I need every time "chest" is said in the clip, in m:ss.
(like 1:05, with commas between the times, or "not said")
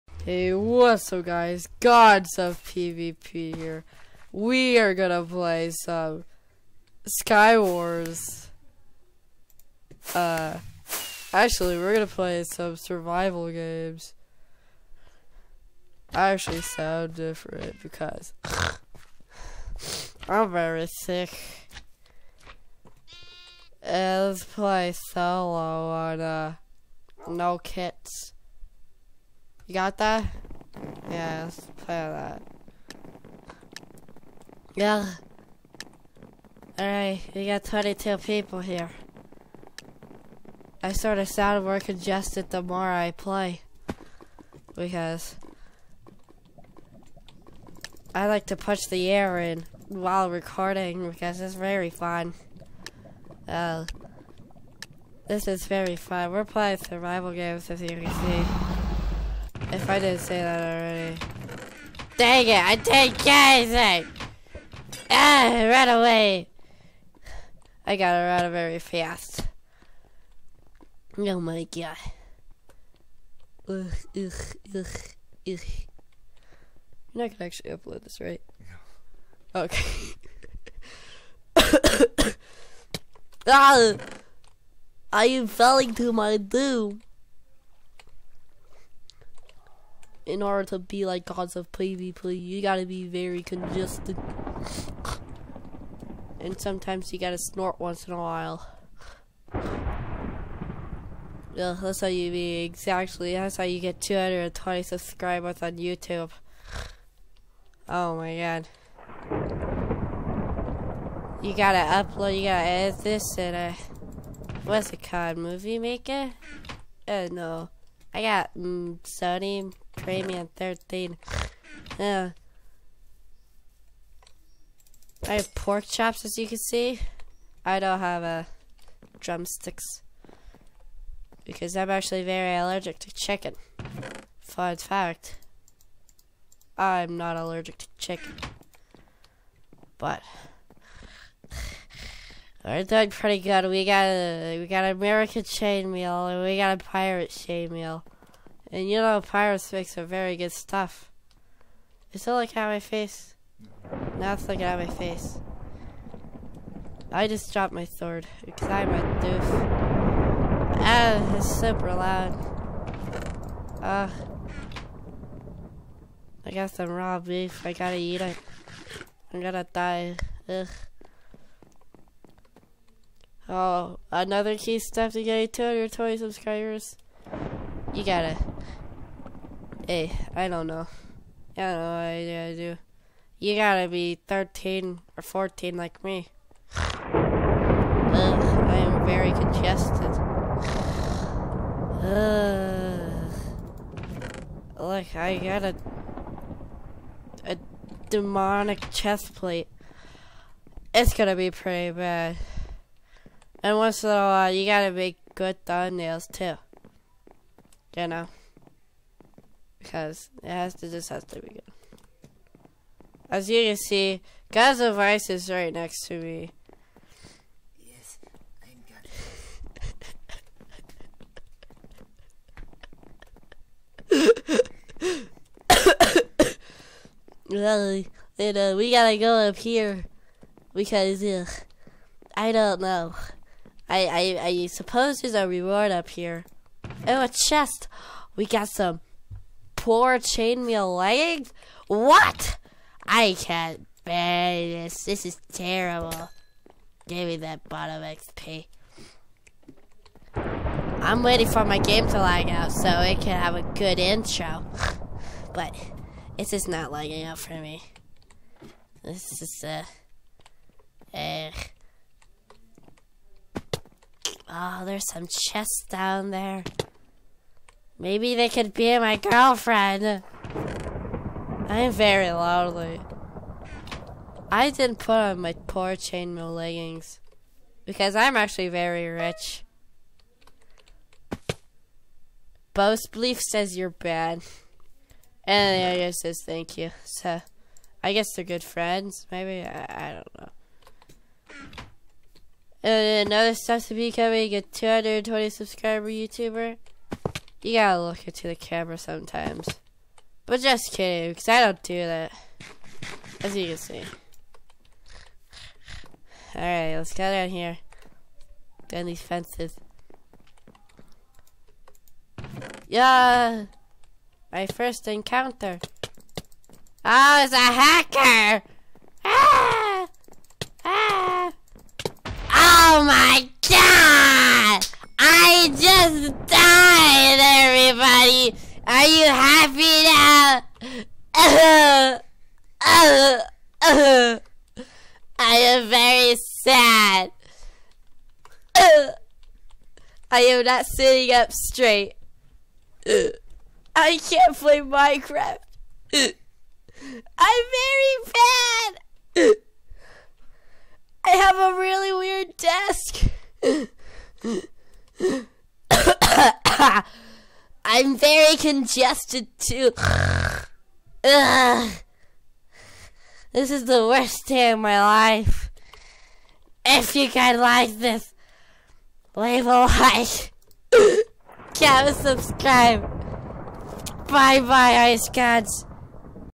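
3:18, 3:57, 4:25.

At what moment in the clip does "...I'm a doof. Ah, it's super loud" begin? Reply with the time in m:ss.
2:38.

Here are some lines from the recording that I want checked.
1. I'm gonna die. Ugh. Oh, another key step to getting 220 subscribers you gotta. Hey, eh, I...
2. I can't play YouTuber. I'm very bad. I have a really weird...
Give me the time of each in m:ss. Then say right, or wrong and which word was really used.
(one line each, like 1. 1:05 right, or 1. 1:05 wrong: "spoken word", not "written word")
1. 2:49 right
2. 5:43 wrong: "Minecraft", not "YouTuber".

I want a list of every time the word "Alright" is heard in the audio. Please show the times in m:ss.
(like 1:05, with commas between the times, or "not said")
0:36, 5:06.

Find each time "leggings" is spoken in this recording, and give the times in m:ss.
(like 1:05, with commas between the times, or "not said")
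4:00, 4:36.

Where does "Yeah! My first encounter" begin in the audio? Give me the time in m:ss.
5:12.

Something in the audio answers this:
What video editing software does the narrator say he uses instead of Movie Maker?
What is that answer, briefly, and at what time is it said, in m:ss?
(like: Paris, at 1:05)
Sony Premium, at 1:58.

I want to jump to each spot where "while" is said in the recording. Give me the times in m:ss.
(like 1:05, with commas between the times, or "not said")
0:49, 1:38, 3:24.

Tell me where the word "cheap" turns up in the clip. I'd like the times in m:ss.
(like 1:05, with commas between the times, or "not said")
not said.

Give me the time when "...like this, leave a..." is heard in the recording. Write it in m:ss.
6:07.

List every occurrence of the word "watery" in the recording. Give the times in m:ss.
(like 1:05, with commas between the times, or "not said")
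not said.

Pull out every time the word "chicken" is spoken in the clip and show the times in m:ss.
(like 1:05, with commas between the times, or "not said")
2:13, 2:17.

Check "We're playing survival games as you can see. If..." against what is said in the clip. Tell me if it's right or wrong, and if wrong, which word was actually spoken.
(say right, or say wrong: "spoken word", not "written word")
right.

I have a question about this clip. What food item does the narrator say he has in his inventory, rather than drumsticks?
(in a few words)
Pork chops.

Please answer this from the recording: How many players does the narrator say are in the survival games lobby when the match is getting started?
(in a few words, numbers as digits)
22.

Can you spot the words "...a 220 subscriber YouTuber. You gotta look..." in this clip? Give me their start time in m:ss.
4:54.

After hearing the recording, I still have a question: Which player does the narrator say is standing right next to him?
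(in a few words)
God's Ice.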